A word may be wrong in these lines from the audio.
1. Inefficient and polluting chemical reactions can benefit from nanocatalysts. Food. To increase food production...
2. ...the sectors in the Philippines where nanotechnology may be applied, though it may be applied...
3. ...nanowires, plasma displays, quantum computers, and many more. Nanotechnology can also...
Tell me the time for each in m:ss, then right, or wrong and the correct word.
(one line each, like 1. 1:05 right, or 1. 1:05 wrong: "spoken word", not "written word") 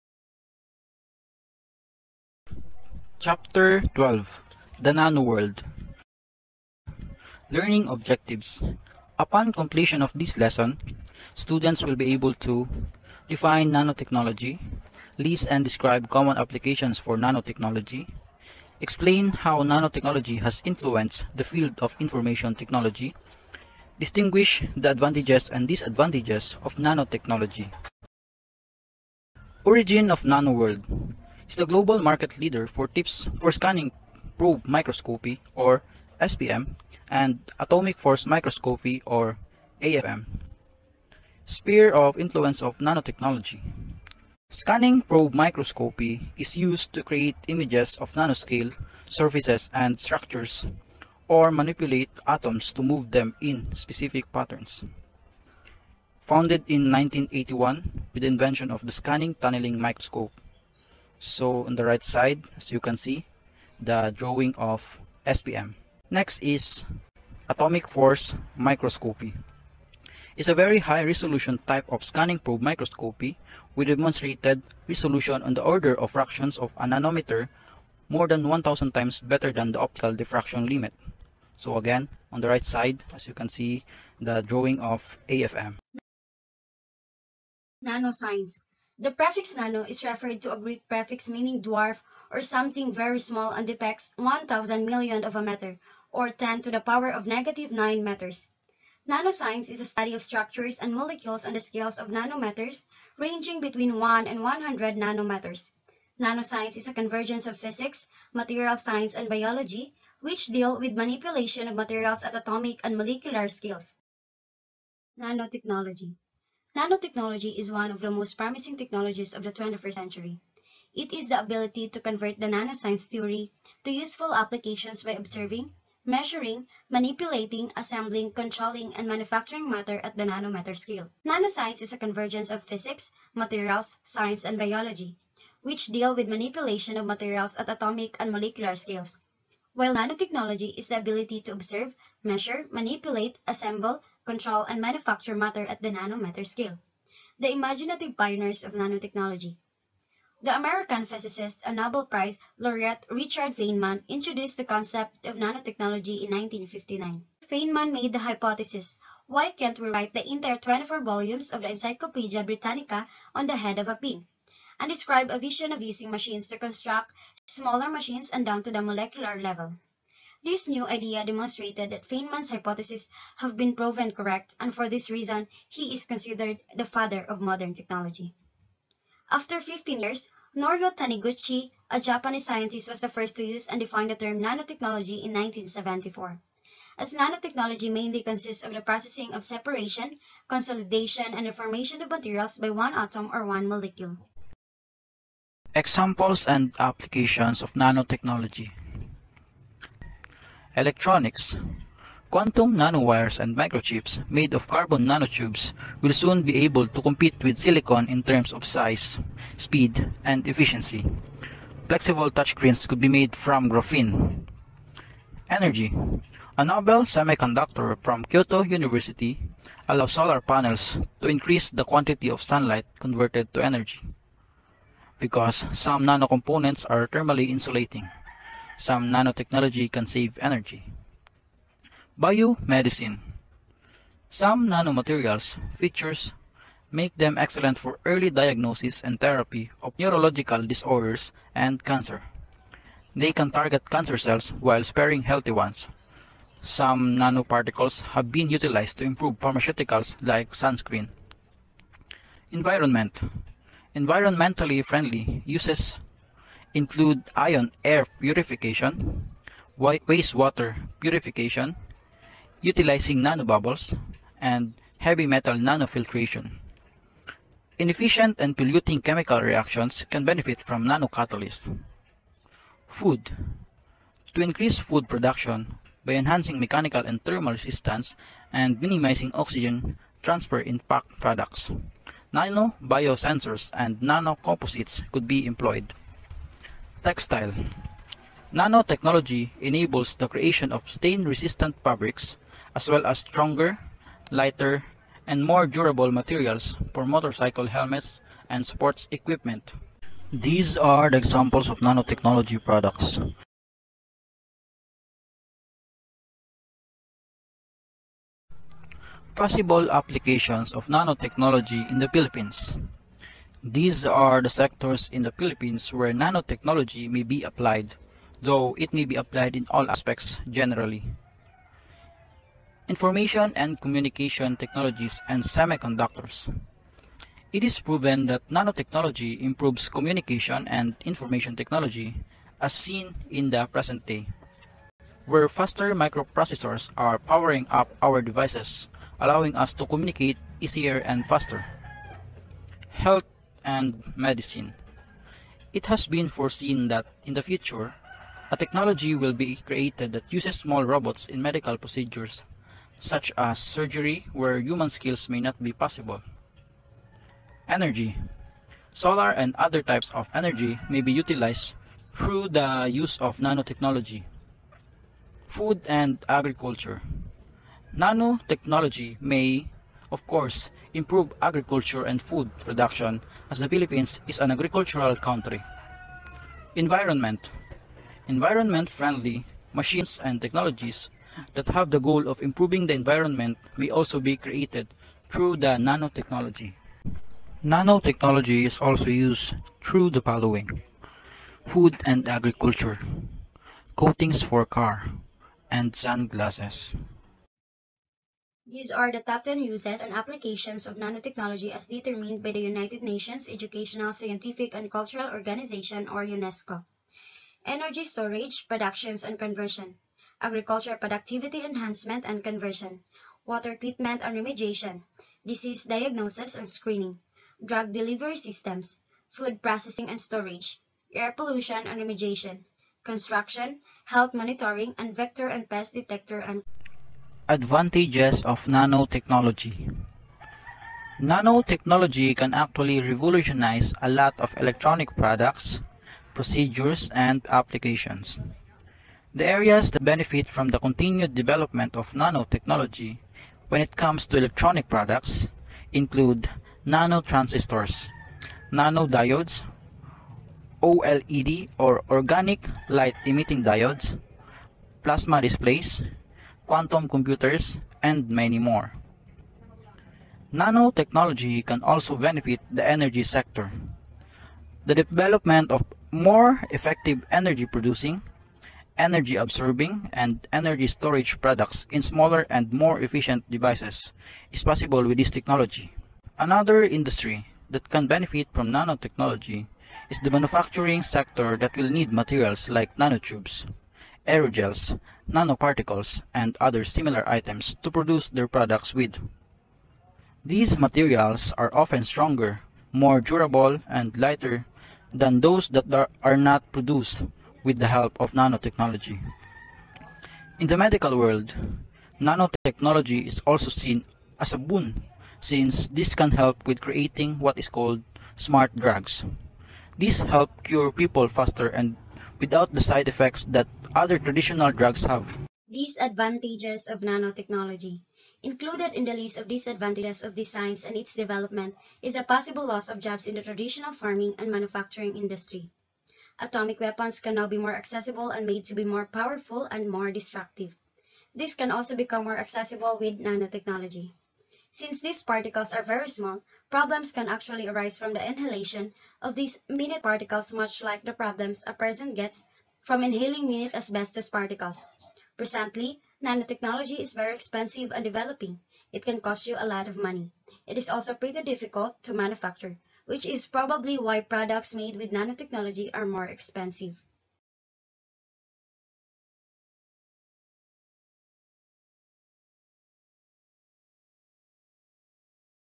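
1. 4:27 right
2. 5:14 right
3. 7:33 wrong: "diodes", not "nanowires".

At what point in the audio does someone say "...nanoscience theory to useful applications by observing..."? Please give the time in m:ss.
2:02.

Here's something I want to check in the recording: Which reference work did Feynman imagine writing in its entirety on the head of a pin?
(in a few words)
Encyclopedia Britannica.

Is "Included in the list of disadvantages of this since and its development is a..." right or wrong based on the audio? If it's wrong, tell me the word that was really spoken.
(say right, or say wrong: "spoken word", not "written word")
wrong: "science", not "since".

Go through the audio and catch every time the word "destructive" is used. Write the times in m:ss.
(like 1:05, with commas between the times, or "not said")
8:50.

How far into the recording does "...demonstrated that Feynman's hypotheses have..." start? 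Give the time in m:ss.
2:51.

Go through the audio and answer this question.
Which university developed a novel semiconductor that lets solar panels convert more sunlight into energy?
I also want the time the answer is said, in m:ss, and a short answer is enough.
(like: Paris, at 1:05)
Kyoto University, at 3:38.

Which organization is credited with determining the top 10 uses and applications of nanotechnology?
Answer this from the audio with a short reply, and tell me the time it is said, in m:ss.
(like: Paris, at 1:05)
UNESCO, at 6:46.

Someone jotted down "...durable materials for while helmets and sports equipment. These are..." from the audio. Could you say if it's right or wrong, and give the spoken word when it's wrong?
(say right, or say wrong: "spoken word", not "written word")
wrong: "motorcycle", not "while".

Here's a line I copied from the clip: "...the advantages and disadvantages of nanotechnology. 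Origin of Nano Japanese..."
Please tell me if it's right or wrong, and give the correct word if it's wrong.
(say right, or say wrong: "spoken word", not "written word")
wrong: "World", not "Japanese".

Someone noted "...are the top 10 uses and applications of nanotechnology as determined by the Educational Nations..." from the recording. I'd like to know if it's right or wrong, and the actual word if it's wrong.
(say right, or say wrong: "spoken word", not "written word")
wrong: "United", not "Educational".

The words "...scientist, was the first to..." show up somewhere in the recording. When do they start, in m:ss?
3:02.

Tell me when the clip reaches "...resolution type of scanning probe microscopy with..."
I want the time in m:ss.
1:11.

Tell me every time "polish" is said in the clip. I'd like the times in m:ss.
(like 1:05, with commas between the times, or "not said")
not said.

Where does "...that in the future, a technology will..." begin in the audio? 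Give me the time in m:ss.
5:46.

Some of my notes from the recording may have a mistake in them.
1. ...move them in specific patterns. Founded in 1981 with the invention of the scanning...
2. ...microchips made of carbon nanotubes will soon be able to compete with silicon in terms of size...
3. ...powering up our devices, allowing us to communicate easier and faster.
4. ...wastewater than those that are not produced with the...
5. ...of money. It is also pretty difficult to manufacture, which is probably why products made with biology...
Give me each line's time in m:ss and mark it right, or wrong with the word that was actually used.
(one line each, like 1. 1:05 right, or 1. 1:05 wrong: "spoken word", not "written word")
1. 0:52 right
2. 3:23 right
3. 5:37 right
4. 8:14 wrong: "lighter", not "wastewater"
5. 9:09 wrong: "nanotechnology", not "biology".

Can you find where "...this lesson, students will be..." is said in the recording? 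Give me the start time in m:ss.
0:10.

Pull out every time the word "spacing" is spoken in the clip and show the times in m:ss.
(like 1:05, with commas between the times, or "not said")
not said.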